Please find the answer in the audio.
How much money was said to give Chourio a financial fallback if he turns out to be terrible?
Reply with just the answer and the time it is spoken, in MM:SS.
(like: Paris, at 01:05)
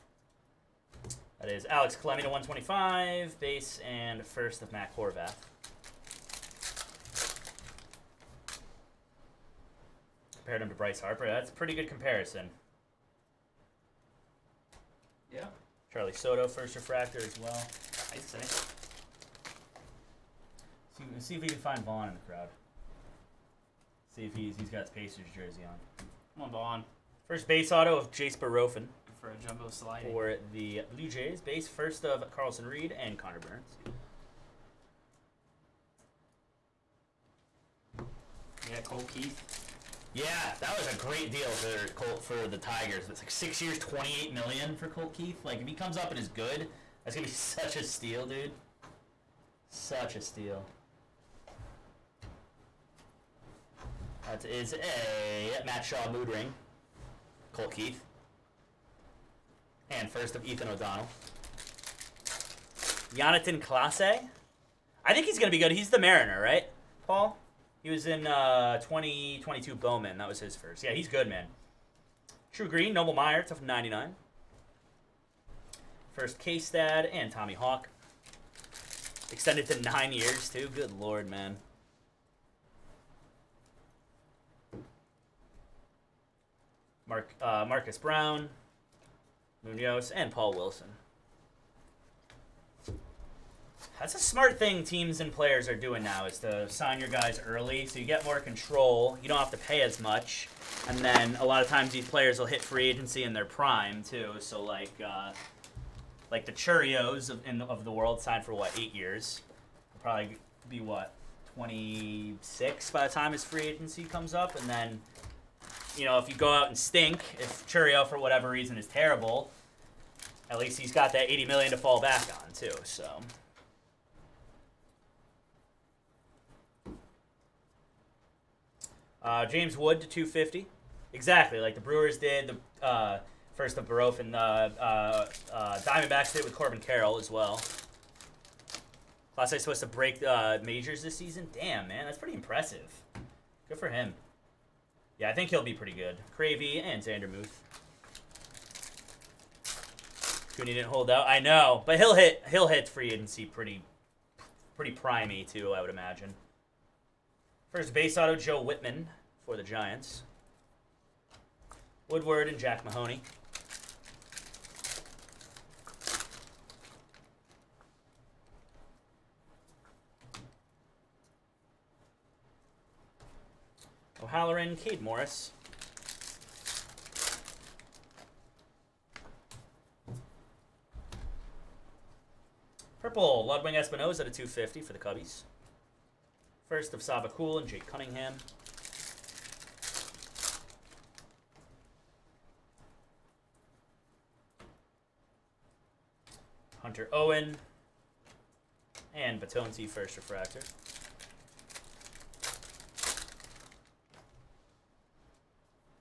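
$80 million, at 02:01.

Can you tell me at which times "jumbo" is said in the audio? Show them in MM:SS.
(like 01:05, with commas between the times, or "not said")
00:29.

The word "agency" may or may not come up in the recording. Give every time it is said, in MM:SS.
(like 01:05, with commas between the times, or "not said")
01:42, 01:53, 02:33.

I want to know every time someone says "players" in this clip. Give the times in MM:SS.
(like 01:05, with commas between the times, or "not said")
01:35, 01:42.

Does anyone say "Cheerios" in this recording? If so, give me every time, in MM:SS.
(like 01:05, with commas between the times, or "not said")
01:46.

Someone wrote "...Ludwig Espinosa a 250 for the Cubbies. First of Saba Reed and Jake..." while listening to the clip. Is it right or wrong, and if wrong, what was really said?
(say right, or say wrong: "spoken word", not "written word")
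wrong: "Cool", not "Reed".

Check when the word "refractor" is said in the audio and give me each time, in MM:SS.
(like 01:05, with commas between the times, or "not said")
00:16, 03:20.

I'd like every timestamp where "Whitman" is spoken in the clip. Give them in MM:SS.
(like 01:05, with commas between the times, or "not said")
02:38.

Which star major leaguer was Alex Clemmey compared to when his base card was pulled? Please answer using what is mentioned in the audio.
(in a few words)
Bryce Harper.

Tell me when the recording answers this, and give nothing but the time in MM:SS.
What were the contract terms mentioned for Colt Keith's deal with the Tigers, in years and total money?
00:43.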